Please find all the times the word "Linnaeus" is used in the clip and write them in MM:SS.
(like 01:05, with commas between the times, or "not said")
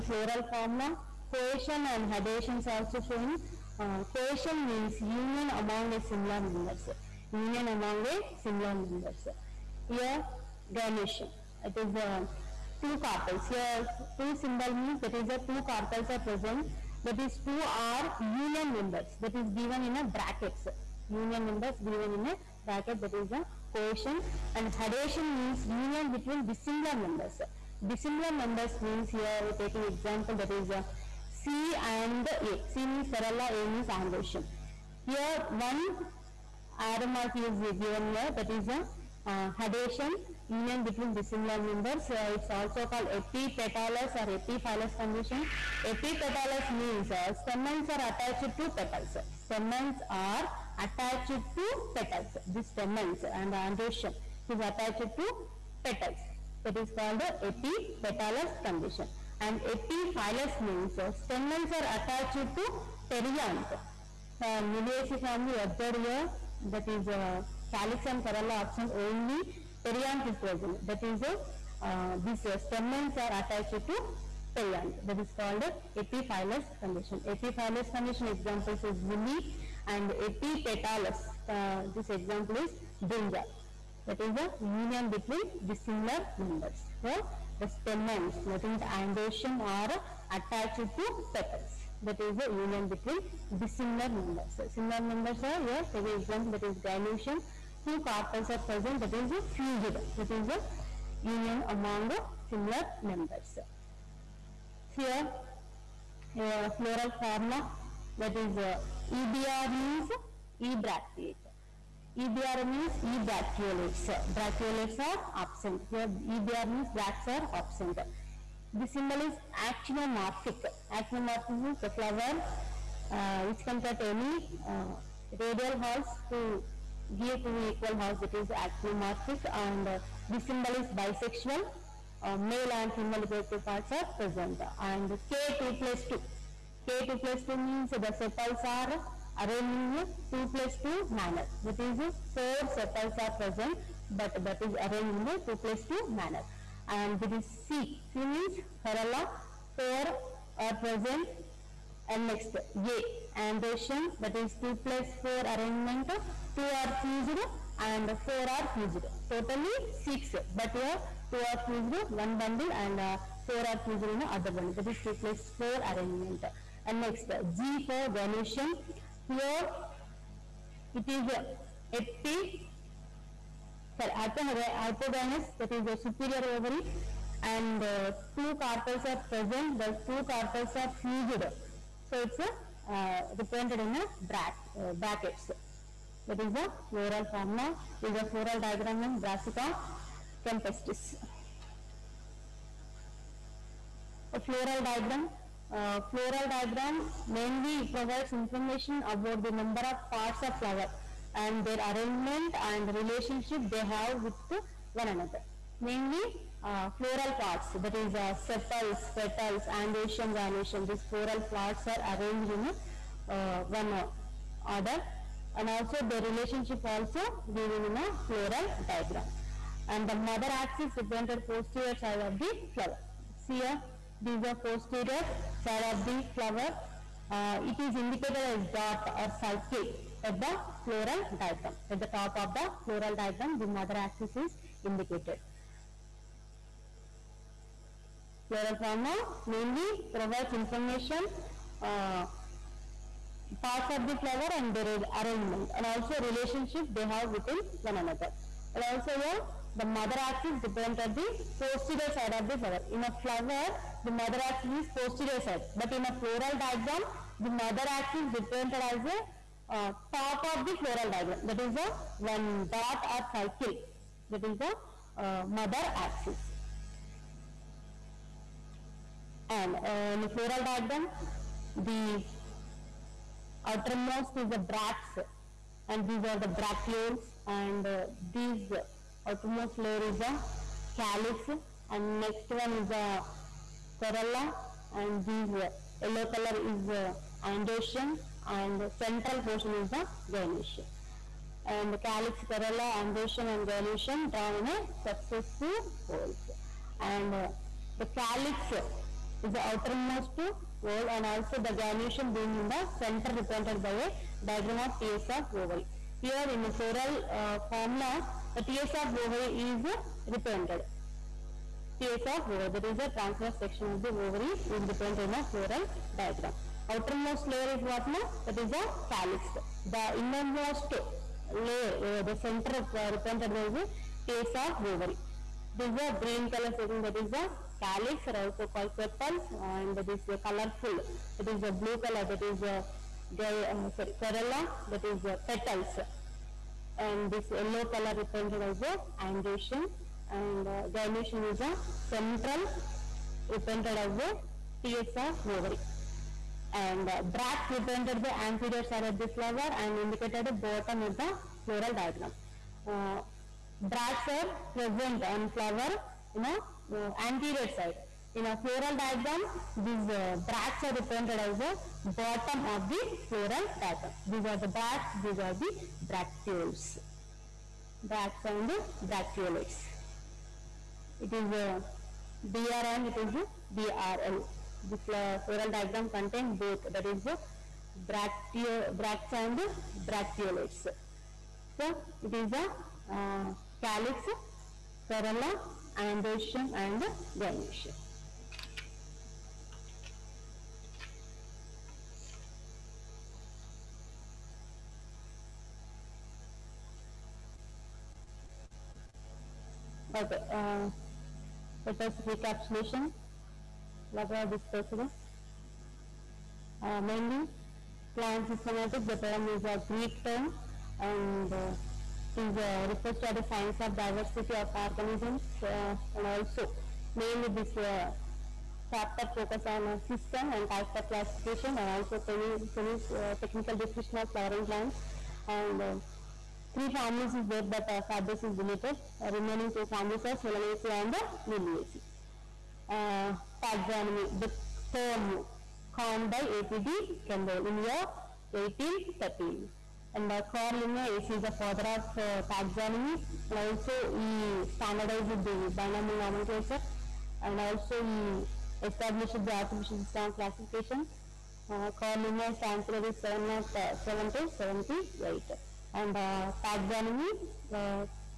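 07:20, 07:32.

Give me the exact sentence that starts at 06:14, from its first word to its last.
This uh, floral diagram contain both that is the uh, bractio, bracts and bracteolates.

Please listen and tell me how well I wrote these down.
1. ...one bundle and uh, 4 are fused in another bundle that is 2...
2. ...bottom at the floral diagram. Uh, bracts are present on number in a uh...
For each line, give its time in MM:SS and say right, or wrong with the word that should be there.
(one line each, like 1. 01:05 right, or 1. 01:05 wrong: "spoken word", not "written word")
1. 02:42 right
2. 05:50 wrong: "flower", not "number".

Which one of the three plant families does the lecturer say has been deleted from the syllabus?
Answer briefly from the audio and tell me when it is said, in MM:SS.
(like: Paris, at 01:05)
Fabaceae, at 07:08.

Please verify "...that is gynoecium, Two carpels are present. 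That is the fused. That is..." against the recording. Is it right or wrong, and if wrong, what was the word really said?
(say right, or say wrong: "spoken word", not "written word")
right.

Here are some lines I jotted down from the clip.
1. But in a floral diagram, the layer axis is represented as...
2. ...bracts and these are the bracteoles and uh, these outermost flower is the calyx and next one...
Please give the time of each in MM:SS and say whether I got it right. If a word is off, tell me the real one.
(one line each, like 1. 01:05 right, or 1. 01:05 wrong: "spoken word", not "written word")
1. 04:15 wrong: "mother", not "layer"
2. 04:34 wrong: "layer", not "flower".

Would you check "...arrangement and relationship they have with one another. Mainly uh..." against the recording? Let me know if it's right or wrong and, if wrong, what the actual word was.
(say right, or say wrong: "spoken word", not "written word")
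right.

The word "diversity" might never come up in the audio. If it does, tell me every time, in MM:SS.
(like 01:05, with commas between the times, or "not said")
06:53.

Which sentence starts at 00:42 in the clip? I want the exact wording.
Uh, it's also called epipetalous or epiphyllous condition.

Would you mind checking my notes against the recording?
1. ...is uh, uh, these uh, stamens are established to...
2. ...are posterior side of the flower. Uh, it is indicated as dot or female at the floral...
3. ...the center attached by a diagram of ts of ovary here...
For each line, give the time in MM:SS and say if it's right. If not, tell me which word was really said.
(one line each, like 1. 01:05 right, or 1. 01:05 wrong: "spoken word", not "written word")
1. 01:11 wrong: "attached", not "established"
2. 03:44 wrong: "circle", not "female"
3. 05:02 wrong: "represented", not "attached".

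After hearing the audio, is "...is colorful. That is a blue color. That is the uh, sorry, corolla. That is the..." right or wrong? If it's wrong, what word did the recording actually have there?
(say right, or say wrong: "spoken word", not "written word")
right.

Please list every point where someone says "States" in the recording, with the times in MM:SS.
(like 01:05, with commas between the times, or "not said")
05:11, 05:24.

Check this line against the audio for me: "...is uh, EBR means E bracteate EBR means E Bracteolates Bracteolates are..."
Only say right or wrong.
right.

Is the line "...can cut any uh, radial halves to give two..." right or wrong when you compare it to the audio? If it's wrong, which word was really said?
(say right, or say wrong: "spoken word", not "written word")
right.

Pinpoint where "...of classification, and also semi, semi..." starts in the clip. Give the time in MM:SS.
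07:00.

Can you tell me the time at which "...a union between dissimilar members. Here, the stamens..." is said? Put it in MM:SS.
01:24.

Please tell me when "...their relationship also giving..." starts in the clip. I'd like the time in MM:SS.
03:36.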